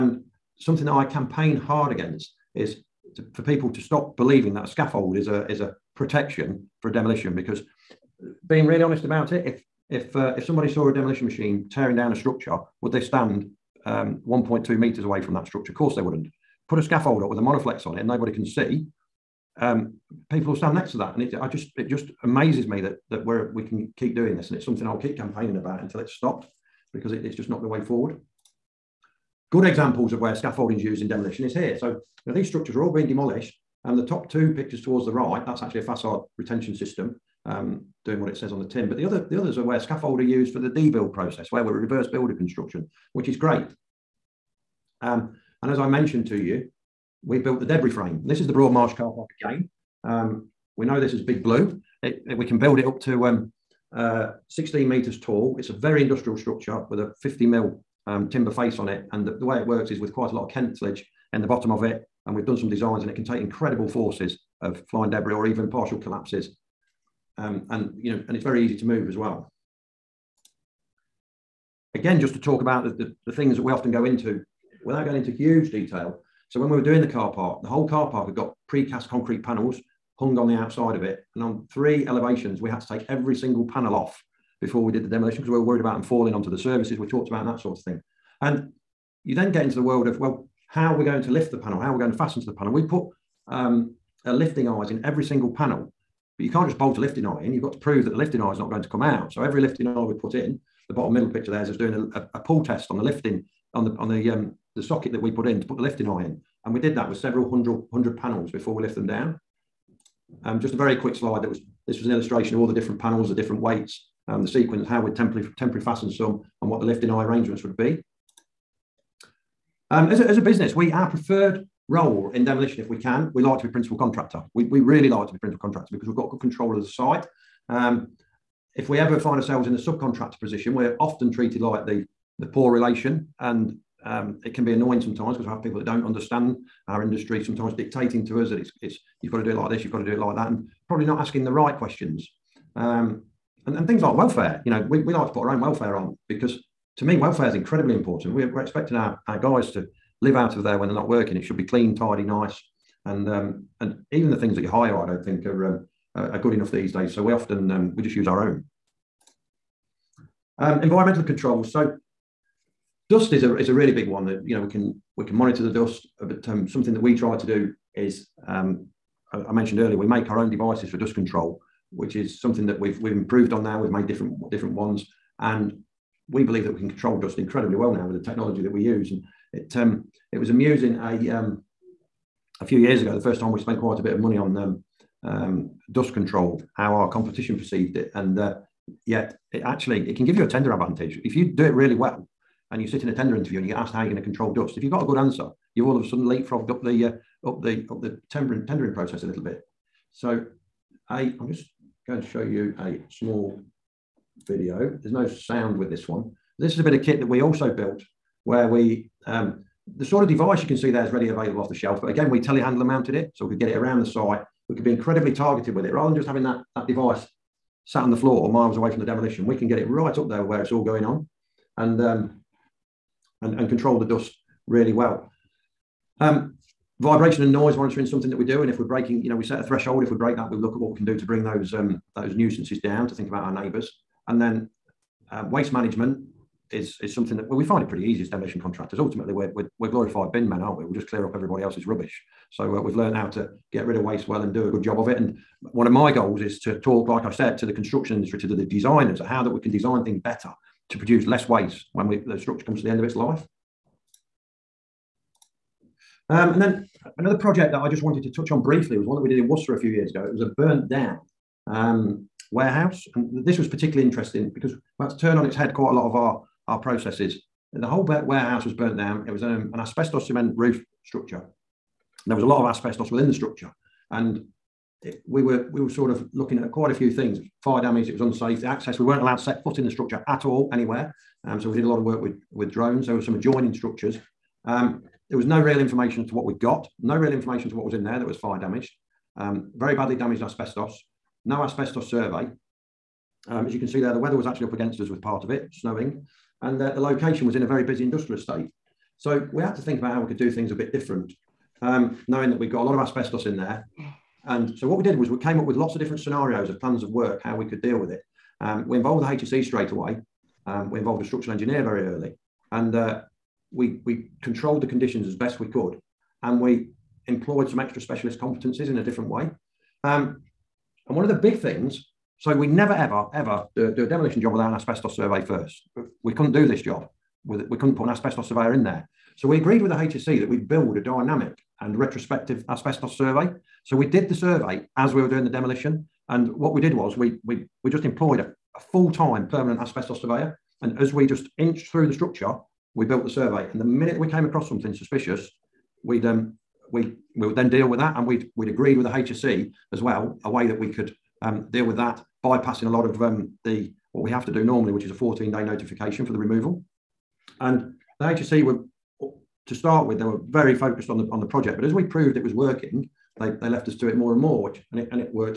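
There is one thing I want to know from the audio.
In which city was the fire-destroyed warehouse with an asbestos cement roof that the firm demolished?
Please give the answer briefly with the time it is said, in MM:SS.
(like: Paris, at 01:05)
Worcester, at 04:19.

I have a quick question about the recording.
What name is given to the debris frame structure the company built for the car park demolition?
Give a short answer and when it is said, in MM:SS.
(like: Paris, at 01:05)
Big Blue, at 00:51.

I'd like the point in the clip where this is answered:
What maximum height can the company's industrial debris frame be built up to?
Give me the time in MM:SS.
00:54.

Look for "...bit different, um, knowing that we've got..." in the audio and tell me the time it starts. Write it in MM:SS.
05:00.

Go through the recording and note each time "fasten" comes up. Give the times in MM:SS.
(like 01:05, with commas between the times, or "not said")
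01:32, 01:55.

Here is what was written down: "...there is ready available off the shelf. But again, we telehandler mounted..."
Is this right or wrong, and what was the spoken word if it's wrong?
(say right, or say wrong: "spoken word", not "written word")
right.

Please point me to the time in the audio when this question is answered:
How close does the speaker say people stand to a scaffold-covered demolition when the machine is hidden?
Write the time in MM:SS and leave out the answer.
00:14.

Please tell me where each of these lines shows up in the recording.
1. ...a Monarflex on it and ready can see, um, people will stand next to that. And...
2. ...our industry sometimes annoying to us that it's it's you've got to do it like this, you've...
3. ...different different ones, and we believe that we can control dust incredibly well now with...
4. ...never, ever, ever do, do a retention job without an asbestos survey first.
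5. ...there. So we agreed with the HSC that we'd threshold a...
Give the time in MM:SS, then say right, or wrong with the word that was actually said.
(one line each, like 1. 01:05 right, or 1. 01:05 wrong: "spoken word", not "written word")
1. 00:17 wrong: "nobody", not "ready"
2. 02:16 wrong: "dictating", not "annoying"
3. 02:54 right
4. 05:22 wrong: "demolition", not "retention"
5. 05:28 wrong: "build", not "threshold".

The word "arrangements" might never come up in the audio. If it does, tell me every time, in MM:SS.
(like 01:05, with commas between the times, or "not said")
01:57.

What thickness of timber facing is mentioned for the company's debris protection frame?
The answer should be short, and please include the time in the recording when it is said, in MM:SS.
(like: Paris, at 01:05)
50 mil, at 00:57.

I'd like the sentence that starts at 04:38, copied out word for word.
The access, we weren't allowed to set foot in the structure at all, anywhere.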